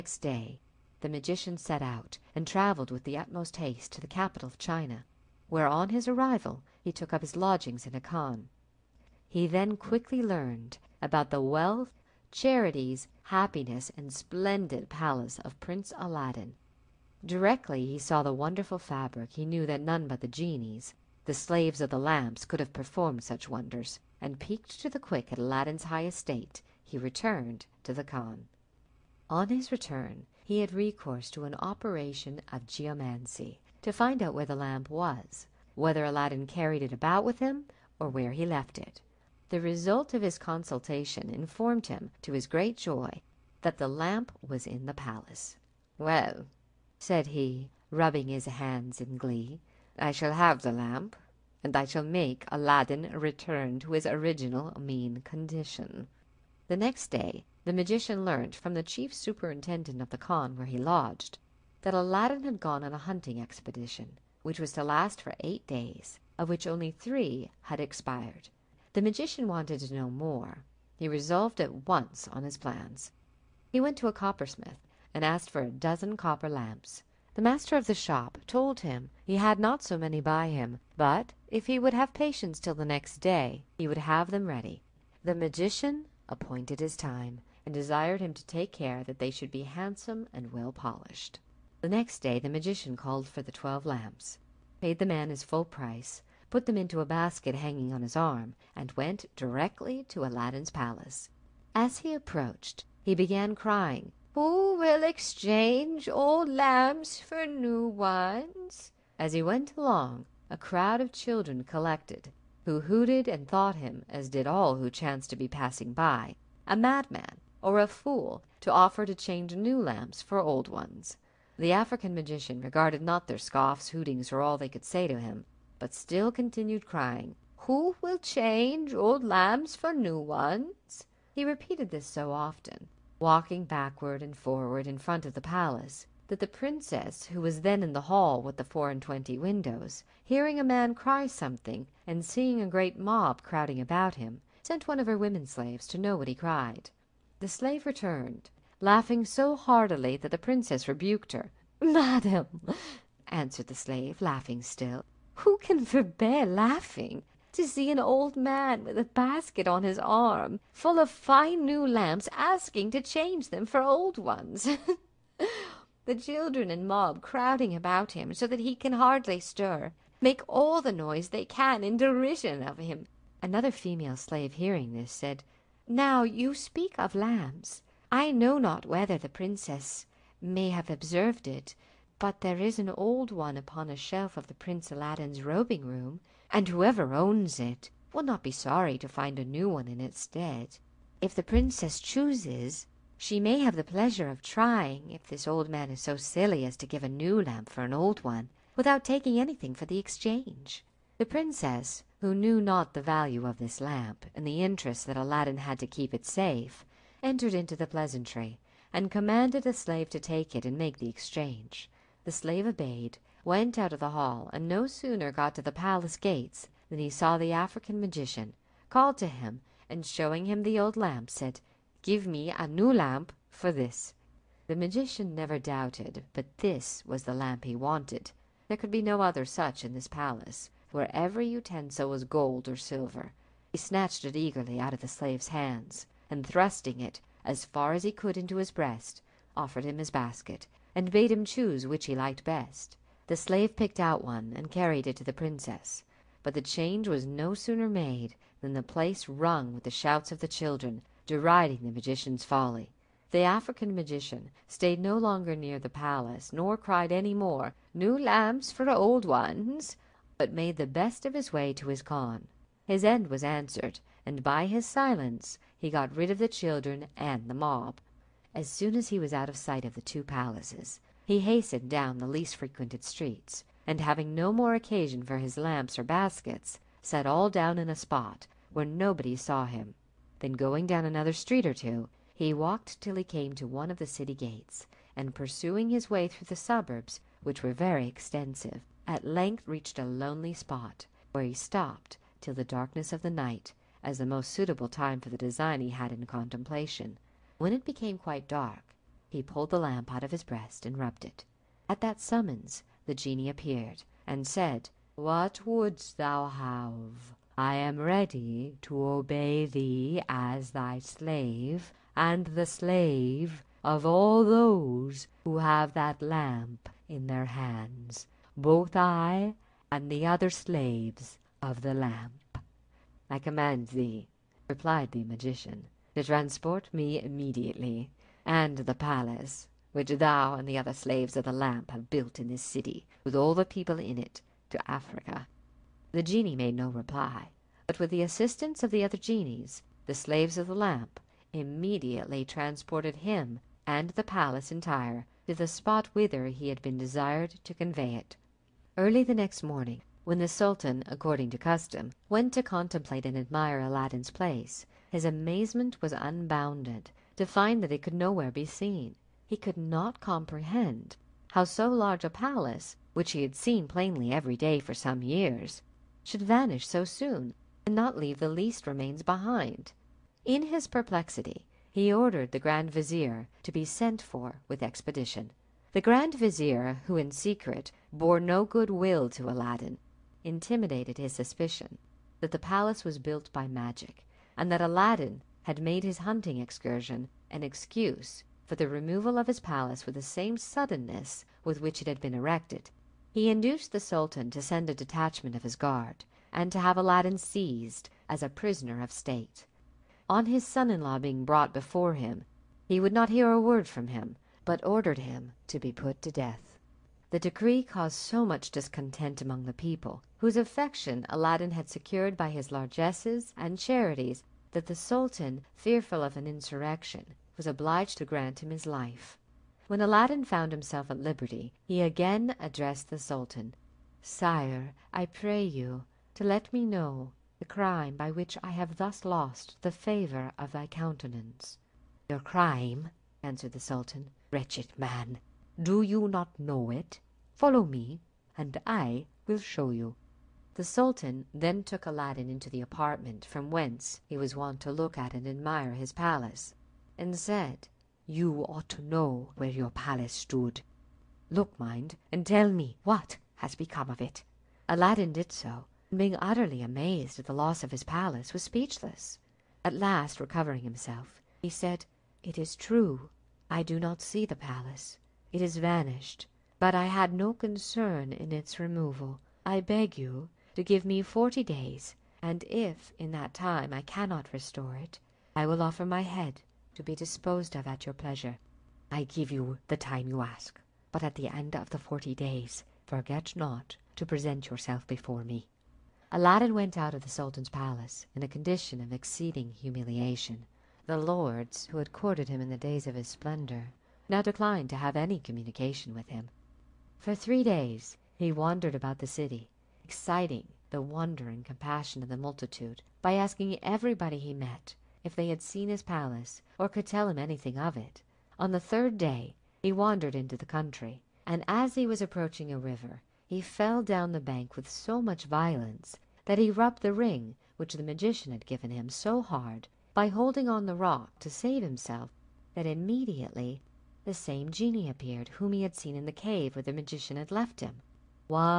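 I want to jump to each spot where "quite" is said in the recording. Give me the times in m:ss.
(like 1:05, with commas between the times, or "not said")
4:58.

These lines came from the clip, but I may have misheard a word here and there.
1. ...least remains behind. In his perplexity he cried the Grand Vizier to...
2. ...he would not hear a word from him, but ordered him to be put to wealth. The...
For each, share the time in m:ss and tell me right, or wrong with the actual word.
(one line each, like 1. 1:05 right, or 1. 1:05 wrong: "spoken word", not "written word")
1. 6:08 wrong: "ordered", not "cried"
2. 6:42 wrong: "death", not "wealth".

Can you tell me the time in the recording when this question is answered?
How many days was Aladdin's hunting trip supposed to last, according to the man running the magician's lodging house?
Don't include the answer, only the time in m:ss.
1:05.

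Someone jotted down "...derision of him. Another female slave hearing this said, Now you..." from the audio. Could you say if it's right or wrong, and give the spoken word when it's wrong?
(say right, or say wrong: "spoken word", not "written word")
right.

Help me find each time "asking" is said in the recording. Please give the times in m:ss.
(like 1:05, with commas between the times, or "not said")
2:42, 8:23.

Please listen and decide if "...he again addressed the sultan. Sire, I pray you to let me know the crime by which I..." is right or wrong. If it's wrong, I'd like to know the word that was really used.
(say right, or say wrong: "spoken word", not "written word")
right.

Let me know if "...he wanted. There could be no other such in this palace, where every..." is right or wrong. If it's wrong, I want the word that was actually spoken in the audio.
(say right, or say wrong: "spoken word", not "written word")
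right.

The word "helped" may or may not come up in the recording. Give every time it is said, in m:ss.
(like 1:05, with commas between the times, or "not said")
not said.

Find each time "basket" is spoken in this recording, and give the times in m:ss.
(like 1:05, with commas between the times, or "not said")
1:37, 2:39, 4:00, 4:36.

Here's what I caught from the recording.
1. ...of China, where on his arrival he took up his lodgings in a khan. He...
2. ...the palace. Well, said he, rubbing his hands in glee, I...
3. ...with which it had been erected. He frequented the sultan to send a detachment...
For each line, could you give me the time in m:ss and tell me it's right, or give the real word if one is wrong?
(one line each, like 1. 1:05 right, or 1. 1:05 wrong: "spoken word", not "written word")
1. 0:04 right
2. 0:44 right
3. 6:31 wrong: "induced", not "frequented".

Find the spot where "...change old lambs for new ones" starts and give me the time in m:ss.
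2:08.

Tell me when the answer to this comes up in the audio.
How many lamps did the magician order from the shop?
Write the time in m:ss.
1:15.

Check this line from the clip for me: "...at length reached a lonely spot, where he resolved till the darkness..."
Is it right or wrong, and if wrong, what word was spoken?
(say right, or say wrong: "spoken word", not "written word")
wrong: "stopped", not "resolved".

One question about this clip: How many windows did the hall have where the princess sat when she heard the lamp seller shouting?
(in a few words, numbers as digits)
24.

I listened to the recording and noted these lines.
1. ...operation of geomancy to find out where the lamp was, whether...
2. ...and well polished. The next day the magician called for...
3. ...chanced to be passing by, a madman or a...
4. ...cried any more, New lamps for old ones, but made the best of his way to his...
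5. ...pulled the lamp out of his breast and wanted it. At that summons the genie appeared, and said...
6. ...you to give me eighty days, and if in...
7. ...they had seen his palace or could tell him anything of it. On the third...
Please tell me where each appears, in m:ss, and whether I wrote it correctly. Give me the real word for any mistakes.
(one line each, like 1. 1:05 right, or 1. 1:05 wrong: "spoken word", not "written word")
1. 0:31 right
2. 1:30 right
3. 1:54 right
4. 4:16 right
5. 4:59 wrong: "rubbed", not "wanted"
6. 7:50 wrong: "forty", not "eighty"
7. 8:25 right.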